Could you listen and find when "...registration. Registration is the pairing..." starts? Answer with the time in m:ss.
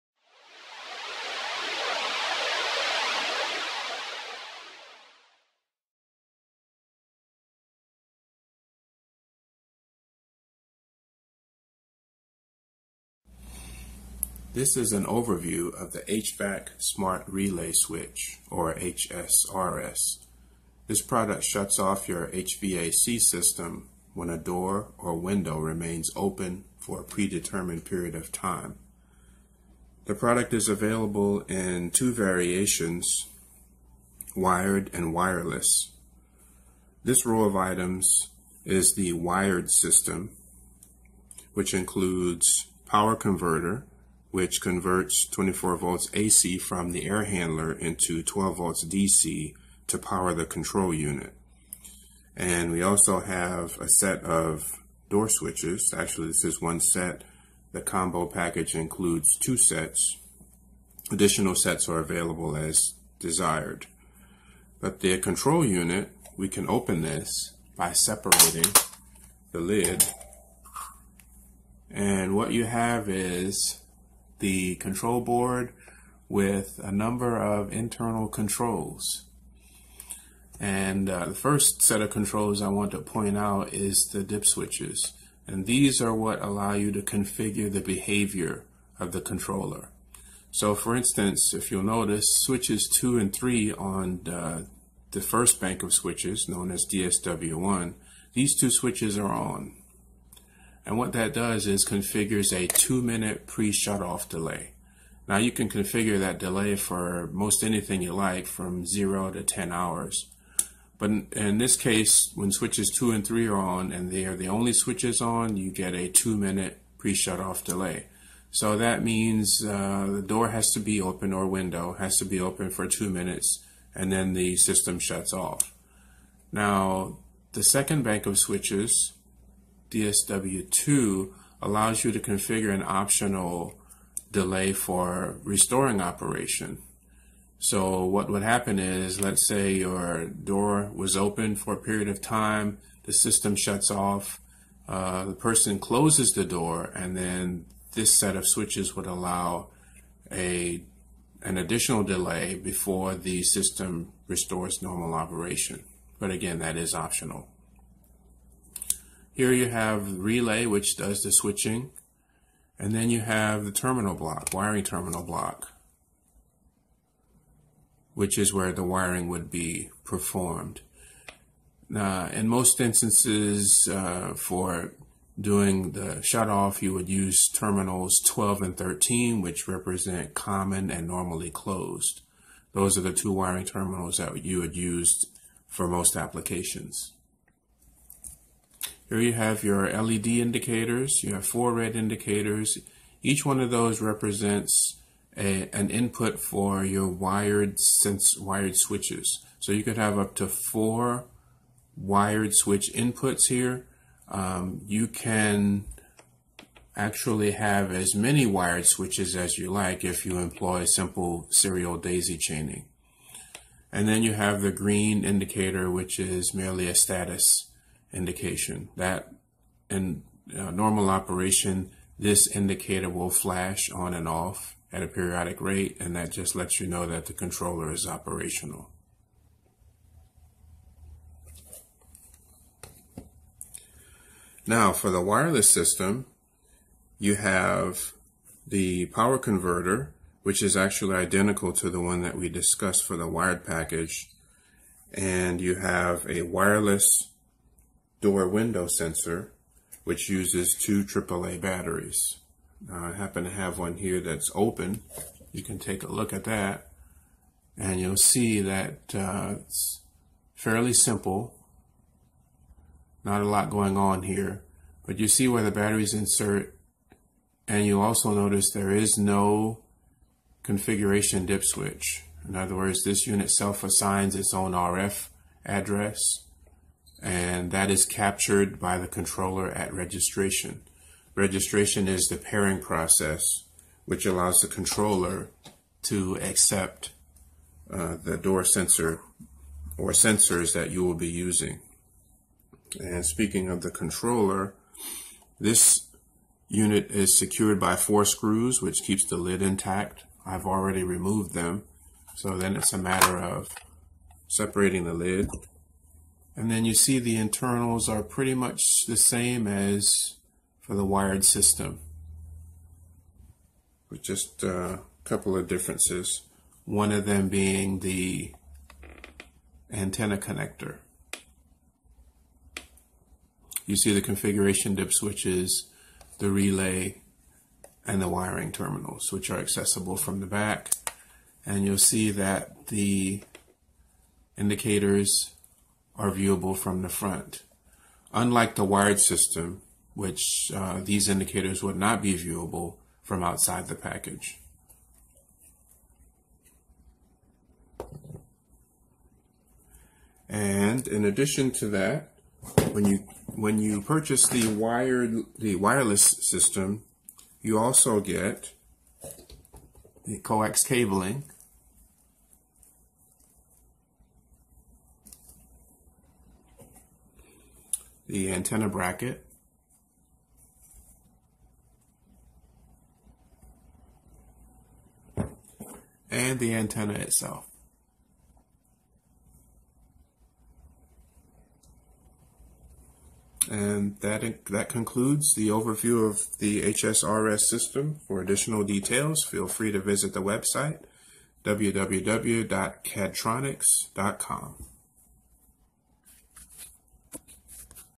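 4:39.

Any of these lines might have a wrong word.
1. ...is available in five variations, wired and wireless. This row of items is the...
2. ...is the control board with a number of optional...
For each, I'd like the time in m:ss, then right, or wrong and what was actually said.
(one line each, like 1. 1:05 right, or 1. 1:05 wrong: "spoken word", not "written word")
1. 0:30 wrong: "two", not "five"
2. 1:13 wrong: "internal", not "optional".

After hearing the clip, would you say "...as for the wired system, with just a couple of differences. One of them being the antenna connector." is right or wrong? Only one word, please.
right.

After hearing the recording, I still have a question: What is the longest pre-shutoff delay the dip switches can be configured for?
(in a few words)
10 hours.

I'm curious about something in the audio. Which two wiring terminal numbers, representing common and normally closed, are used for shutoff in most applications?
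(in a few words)
12 and 13.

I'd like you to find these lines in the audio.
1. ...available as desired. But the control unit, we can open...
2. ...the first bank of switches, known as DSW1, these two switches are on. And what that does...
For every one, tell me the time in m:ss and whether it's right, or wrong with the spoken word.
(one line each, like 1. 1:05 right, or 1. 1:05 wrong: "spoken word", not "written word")
1. 1:01 right
2. 1:35 right.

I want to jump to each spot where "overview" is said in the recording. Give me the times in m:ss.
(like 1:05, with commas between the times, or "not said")
0:15, 6:25.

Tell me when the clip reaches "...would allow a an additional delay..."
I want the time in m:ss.
2:28.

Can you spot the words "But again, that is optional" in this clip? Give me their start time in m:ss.
2:36.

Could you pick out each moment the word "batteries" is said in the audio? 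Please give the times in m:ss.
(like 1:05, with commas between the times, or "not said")
4:11, 4:25.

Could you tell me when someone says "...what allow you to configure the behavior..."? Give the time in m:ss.
1:26.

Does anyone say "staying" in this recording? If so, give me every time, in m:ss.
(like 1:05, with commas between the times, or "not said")
not said.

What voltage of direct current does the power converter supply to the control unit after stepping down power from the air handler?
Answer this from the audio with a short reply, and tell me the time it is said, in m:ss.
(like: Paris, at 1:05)
12 volts DC, at 0:48.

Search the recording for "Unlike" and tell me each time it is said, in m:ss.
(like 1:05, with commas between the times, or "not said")
5:38.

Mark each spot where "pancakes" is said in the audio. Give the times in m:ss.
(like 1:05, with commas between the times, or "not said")
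not said.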